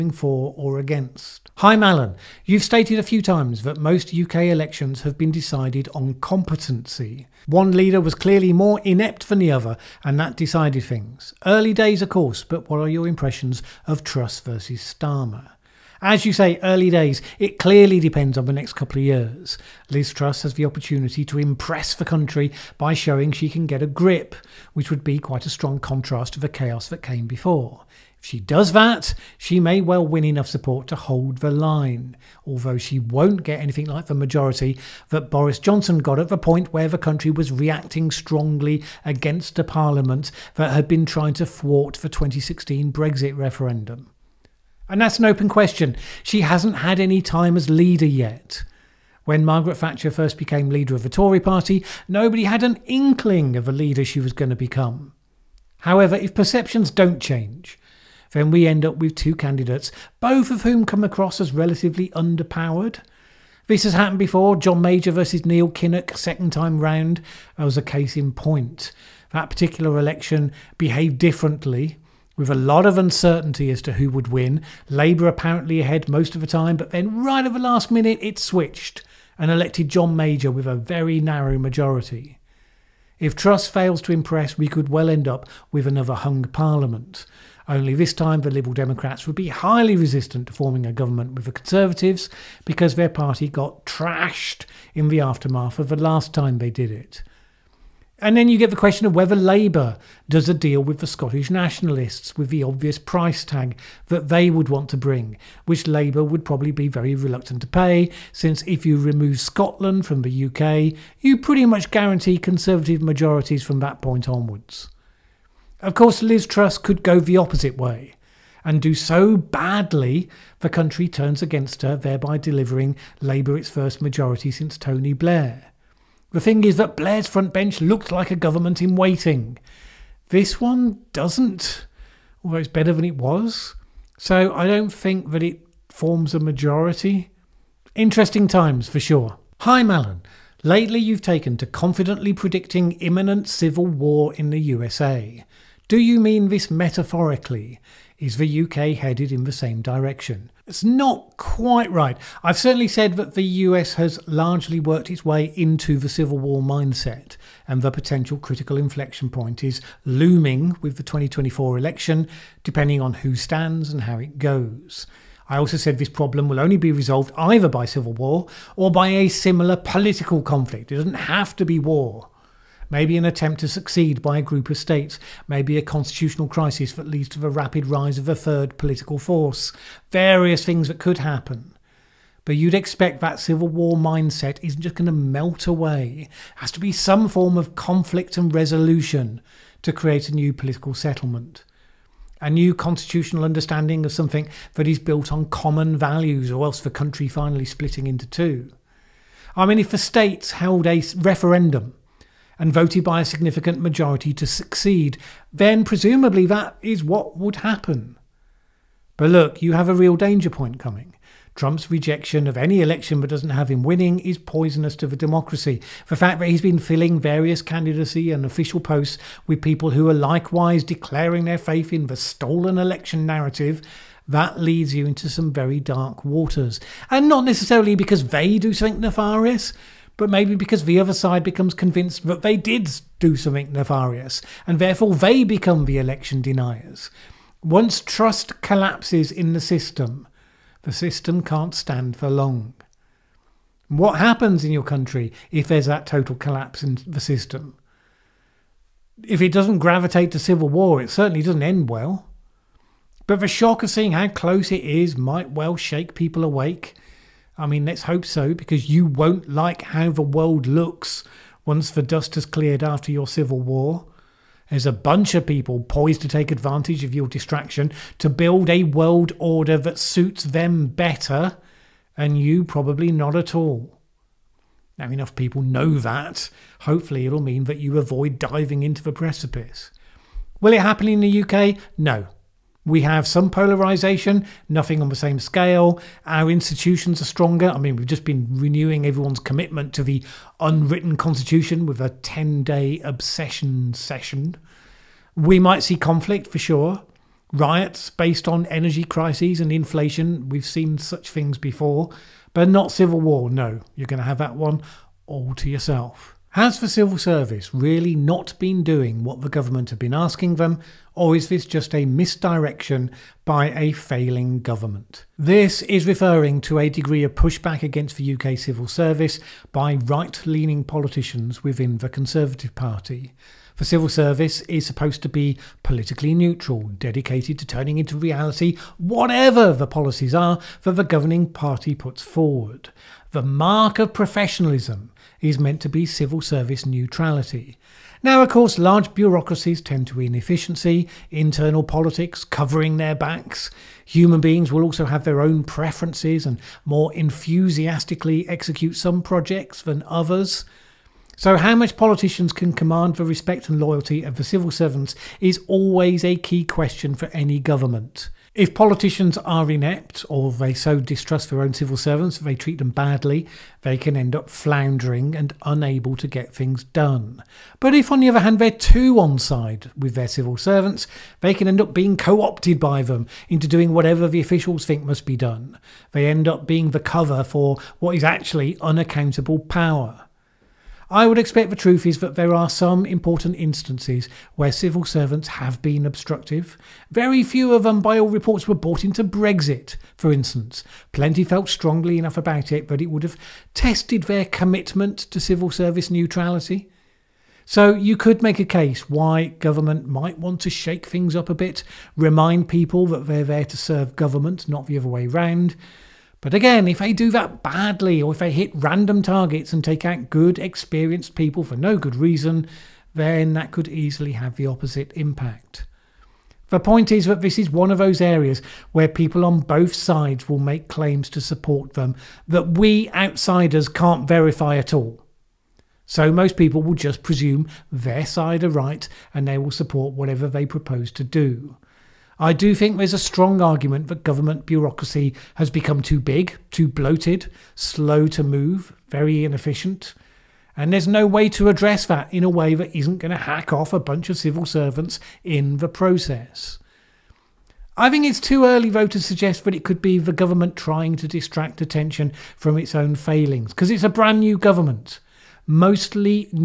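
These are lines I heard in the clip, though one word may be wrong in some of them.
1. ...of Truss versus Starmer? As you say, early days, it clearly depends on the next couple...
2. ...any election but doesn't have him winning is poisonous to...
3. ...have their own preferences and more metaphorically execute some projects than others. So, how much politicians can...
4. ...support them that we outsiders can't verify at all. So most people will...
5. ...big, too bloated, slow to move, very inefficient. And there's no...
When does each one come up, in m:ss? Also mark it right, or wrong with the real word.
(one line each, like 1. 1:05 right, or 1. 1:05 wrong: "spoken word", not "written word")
1. 0:13 right
2. 3:32 right
3. 5:45 wrong: "enthusiastically", not "metaphorically"
4. 7:01 right
5. 7:16 right.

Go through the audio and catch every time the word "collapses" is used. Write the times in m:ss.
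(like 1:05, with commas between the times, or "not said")
3:58, 4:06.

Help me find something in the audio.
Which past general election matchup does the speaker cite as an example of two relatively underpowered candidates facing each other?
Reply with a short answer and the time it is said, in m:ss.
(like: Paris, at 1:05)
John Major versus Neil Kinnock, at 1:04.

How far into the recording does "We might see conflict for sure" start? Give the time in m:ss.
4:55.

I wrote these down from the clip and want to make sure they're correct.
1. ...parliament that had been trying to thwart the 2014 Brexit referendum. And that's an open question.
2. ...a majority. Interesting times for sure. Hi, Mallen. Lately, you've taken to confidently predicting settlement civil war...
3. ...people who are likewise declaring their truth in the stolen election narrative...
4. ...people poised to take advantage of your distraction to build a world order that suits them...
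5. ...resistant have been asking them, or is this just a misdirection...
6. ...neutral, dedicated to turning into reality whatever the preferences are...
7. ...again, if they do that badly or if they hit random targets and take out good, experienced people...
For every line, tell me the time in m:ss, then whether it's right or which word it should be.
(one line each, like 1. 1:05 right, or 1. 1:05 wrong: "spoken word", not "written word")
1. 0:39 wrong: "2016", not "2014"
2. 2:16 wrong: "imminent", not "settlement"
3. 3:39 wrong: "faith", not "truth"
4. 4:25 right
5. 5:09 wrong: "government", not "resistant"
6. 5:26 wrong: "policies", not "preferences"
7. 6:46 right.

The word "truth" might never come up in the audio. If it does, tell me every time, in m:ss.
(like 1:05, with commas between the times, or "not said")
6:21.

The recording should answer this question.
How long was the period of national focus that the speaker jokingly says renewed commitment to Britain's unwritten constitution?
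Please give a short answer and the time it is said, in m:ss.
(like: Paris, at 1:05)
10 days, at 4:52.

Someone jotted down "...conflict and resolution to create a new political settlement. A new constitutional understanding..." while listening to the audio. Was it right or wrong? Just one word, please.
right.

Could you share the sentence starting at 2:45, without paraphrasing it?
I also said this problem will only be resolved either by civil war or by a similar political conflict.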